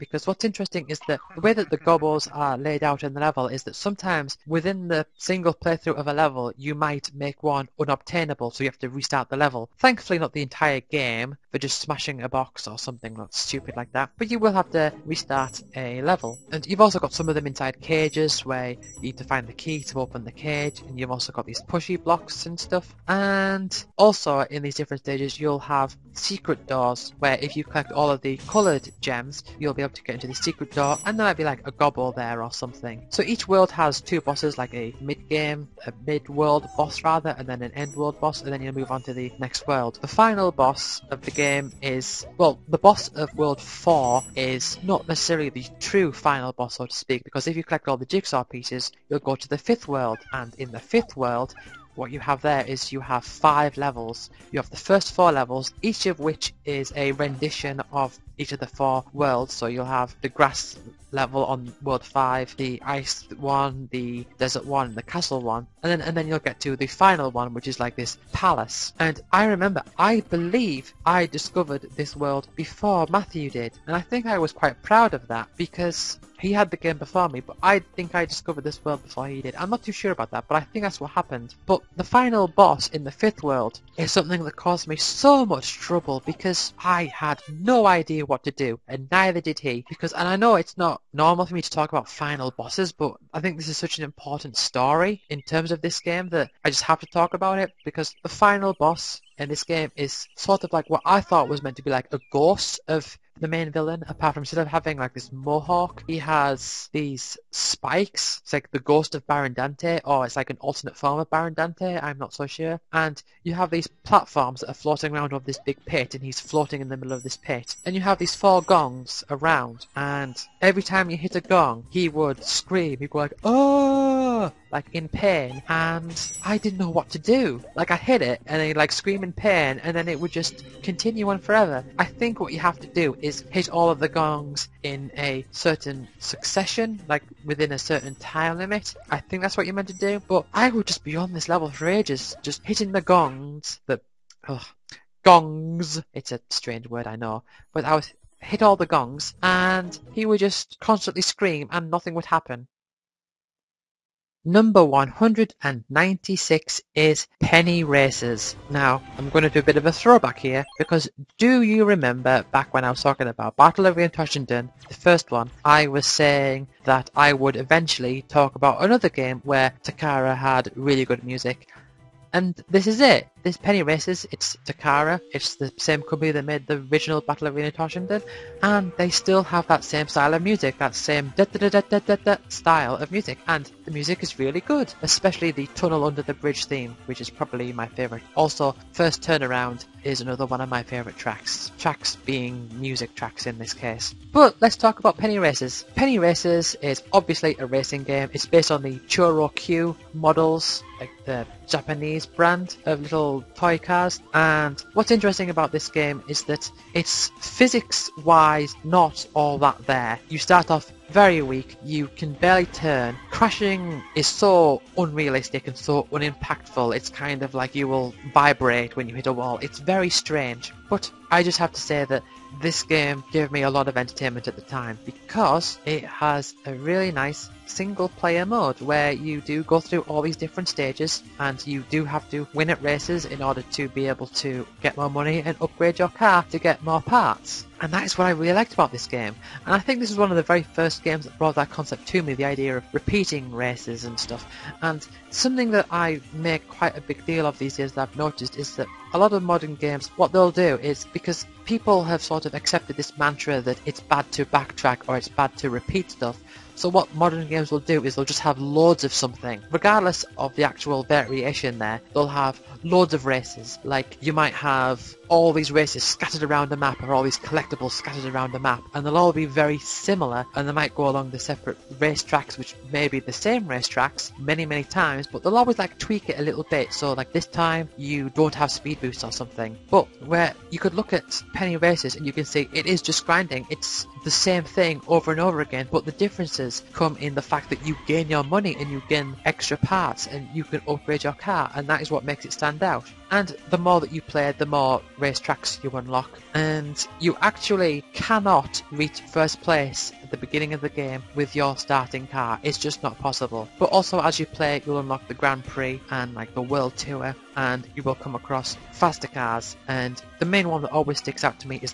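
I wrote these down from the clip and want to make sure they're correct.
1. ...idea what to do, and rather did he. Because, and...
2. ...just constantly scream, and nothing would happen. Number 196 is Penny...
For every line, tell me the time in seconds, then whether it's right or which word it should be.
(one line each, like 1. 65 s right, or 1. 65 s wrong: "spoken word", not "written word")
1. 87 s wrong: "neither", not "rather"
2. 150 s right.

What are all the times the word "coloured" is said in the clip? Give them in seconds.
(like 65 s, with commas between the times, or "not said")
28 s.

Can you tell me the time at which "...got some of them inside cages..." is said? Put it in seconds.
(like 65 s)
16 s.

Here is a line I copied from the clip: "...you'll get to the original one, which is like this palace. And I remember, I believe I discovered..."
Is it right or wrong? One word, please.
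wrong.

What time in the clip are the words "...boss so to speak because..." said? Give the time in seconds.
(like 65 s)
46 s.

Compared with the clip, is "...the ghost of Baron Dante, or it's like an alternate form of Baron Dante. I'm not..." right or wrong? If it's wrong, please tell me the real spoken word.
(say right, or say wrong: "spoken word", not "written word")
right.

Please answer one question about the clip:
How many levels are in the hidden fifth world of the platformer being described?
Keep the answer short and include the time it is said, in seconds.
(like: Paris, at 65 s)
5, at 53 s.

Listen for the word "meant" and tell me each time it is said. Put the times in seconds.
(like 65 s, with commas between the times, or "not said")
101 s, 139 s.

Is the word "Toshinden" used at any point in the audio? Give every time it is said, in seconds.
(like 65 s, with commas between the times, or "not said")
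164 s, 177 s.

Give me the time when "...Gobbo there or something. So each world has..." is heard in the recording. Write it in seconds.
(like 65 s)
31 s.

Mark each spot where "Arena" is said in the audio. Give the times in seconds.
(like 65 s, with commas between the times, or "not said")
163 s, 177 s.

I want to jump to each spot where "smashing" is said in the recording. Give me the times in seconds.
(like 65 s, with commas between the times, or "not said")
11 s.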